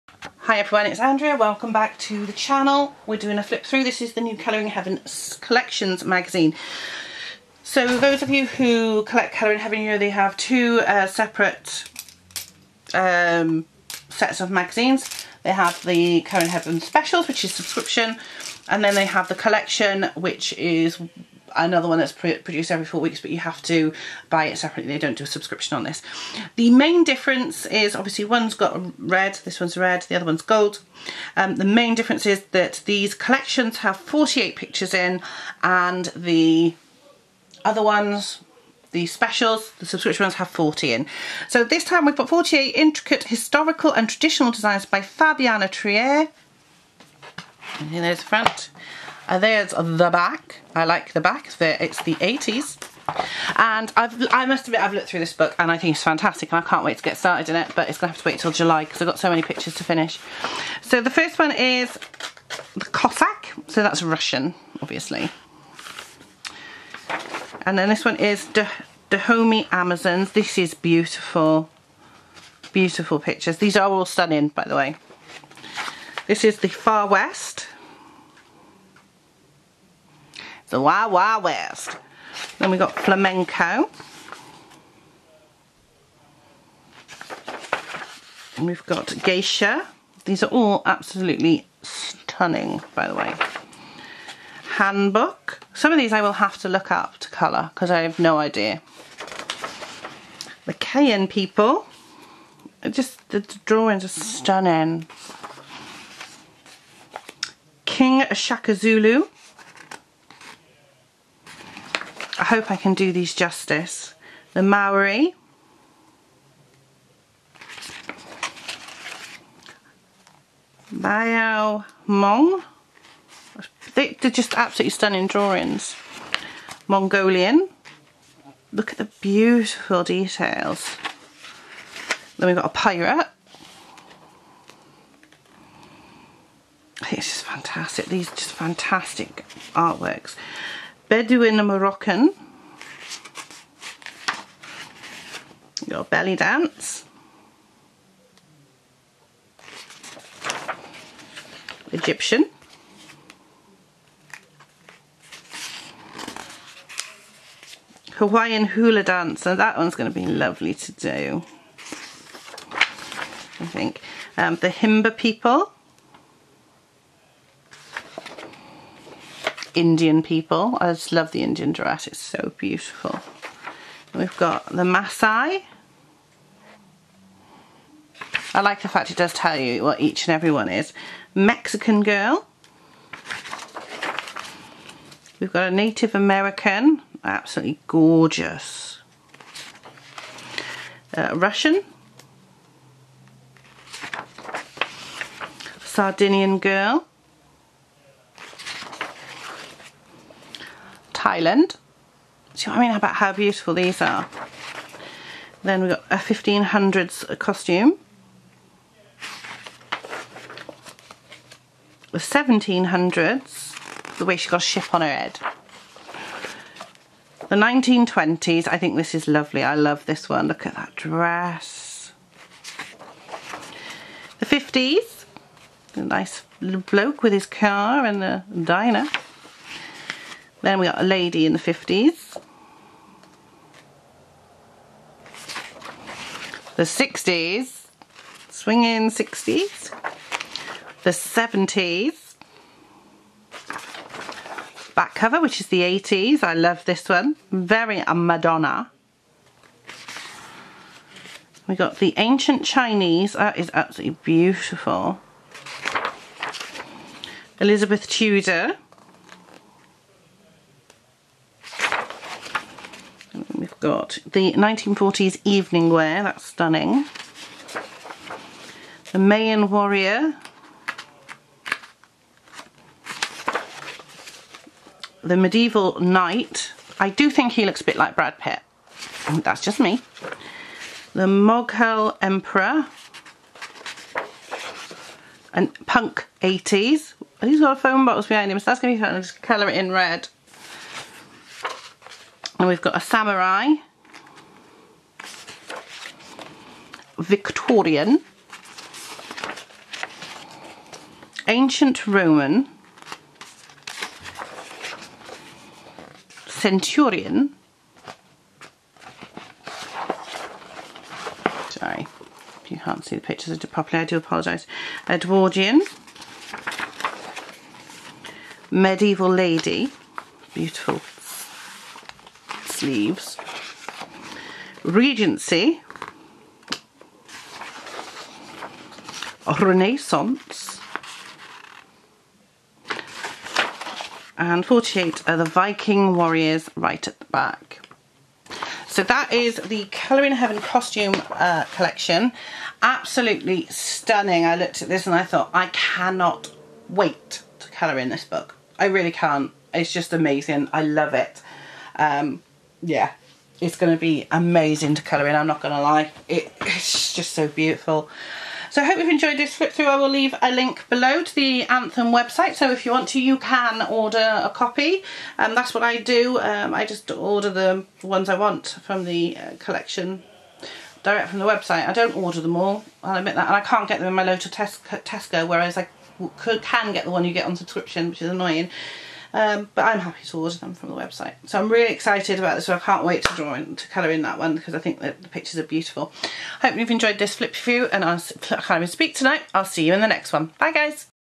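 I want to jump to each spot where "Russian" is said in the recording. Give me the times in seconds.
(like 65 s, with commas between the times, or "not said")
64 s, 191 s.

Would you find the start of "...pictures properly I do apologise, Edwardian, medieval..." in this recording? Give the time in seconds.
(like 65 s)
313 s.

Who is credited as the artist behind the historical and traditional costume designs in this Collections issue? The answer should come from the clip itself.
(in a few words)
Fabiana Trier.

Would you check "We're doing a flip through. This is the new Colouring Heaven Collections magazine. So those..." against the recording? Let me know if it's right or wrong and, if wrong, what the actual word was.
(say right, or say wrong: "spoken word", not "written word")
right.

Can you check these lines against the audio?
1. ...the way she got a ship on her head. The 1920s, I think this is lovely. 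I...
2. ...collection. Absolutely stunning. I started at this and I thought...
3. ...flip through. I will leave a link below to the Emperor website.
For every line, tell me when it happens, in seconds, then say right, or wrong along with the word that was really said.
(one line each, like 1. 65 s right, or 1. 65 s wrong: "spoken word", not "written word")
1. 214 s right
2. 341 s wrong: "looked", not "started"
3. 359 s wrong: "Anthem", not "Emperor".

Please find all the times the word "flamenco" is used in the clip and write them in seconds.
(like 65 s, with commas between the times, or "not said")
82 s.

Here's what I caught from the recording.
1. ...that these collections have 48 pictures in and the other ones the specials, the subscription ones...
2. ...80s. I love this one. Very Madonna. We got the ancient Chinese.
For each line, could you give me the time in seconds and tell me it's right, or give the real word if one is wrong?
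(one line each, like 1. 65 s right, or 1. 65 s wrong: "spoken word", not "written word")
1. 32 s right
2. 245 s right.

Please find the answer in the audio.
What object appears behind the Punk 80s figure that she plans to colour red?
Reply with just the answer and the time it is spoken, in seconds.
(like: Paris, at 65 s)
A phone box, at 287 s.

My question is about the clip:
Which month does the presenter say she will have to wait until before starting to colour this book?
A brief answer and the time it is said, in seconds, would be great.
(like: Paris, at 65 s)
July, at 58 s.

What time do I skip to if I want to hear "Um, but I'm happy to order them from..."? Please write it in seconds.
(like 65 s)
379 s.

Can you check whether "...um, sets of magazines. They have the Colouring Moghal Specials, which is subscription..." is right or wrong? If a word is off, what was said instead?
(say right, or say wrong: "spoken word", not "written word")
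wrong: "Heaven", not "Moghal".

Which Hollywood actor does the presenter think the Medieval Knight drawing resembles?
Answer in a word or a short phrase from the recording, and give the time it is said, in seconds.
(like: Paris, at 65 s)
Brad Pitt, at 278 s.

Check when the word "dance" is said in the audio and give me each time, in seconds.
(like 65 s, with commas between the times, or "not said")
146 s, 159 s.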